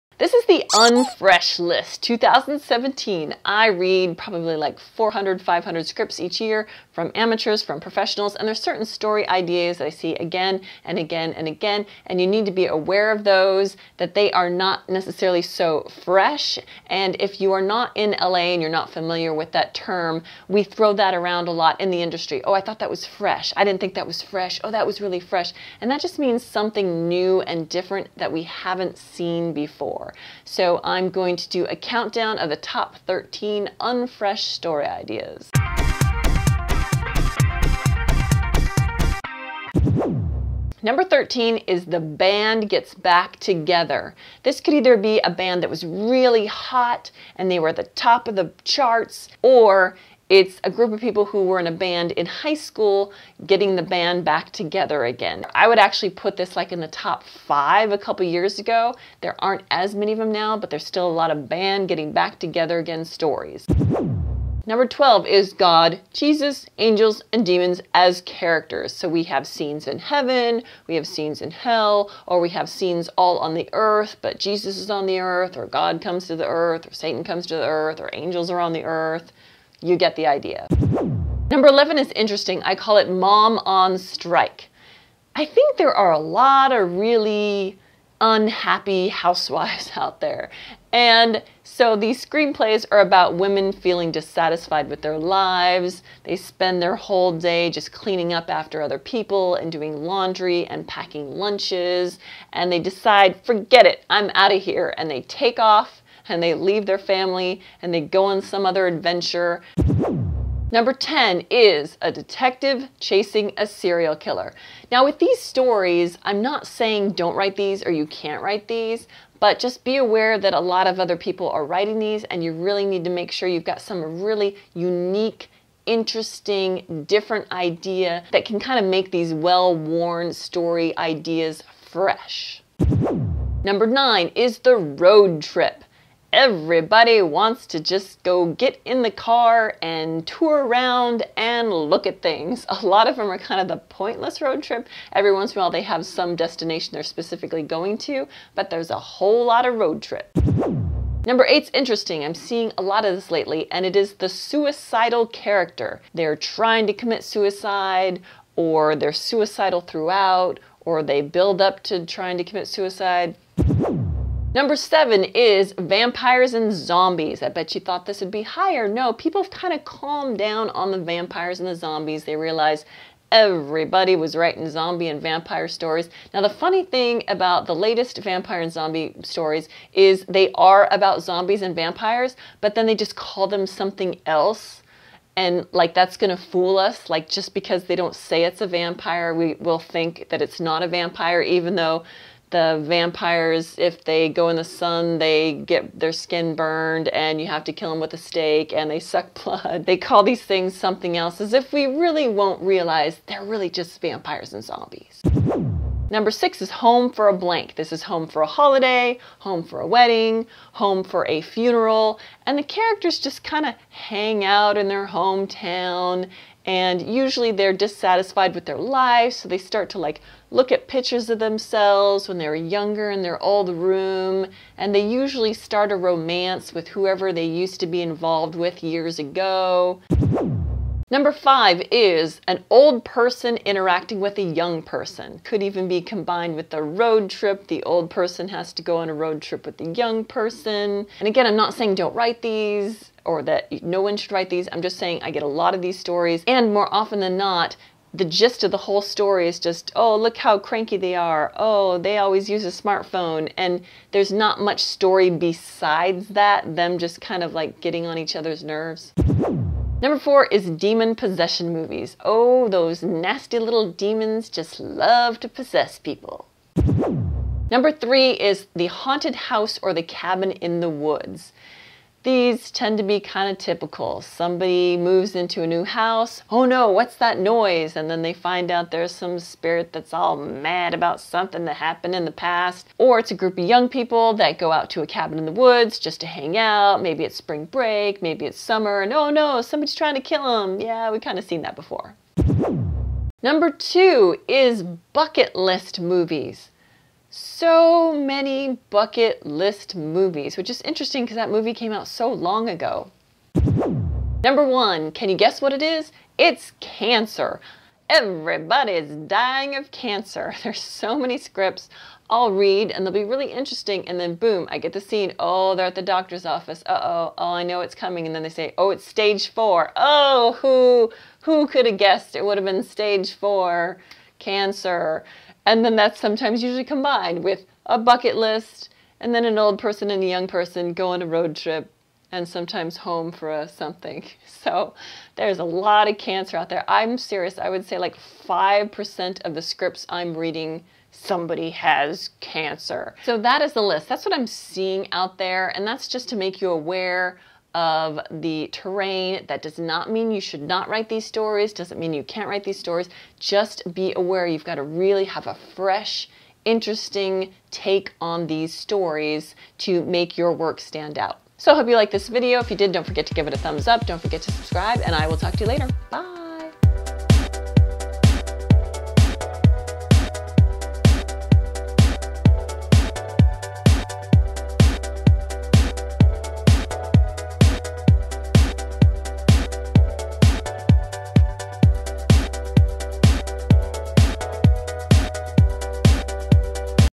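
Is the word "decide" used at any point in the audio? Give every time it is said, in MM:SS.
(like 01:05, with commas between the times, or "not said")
01:42.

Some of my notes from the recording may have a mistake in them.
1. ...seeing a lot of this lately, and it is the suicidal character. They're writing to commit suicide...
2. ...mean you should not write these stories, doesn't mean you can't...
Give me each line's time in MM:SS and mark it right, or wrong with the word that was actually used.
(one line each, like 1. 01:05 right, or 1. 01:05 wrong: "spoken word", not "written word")
1. 02:32 wrong: "trying", not "writing"
2. 05:50 right.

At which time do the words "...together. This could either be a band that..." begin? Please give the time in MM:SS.
00:43.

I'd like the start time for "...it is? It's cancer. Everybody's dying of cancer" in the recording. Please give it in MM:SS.
05:05.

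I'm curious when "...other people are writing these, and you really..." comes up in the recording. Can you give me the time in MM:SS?
02:00.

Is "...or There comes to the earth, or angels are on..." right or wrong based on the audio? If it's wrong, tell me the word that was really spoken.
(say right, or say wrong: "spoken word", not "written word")
wrong: "Satan", not "There".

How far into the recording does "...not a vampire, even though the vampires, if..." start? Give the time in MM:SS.
03:10.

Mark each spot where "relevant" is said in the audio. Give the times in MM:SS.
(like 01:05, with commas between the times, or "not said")
not said.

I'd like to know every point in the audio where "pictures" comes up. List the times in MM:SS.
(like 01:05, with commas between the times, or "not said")
03:40.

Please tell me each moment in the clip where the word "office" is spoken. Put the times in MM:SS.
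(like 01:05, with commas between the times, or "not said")
05:16.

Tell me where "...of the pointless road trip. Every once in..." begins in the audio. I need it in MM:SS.
02:23.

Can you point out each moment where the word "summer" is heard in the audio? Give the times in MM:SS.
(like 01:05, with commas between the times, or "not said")
04:48.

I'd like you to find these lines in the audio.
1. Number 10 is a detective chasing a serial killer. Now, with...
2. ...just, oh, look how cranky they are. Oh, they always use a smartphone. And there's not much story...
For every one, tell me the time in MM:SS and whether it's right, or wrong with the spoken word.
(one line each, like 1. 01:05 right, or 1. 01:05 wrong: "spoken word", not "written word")
1. 01:50 right
2. 04:09 right.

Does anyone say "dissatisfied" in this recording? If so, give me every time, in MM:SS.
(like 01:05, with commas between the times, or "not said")
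01:34, 03:37.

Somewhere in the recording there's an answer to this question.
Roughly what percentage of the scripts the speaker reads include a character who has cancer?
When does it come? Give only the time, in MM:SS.
05:38.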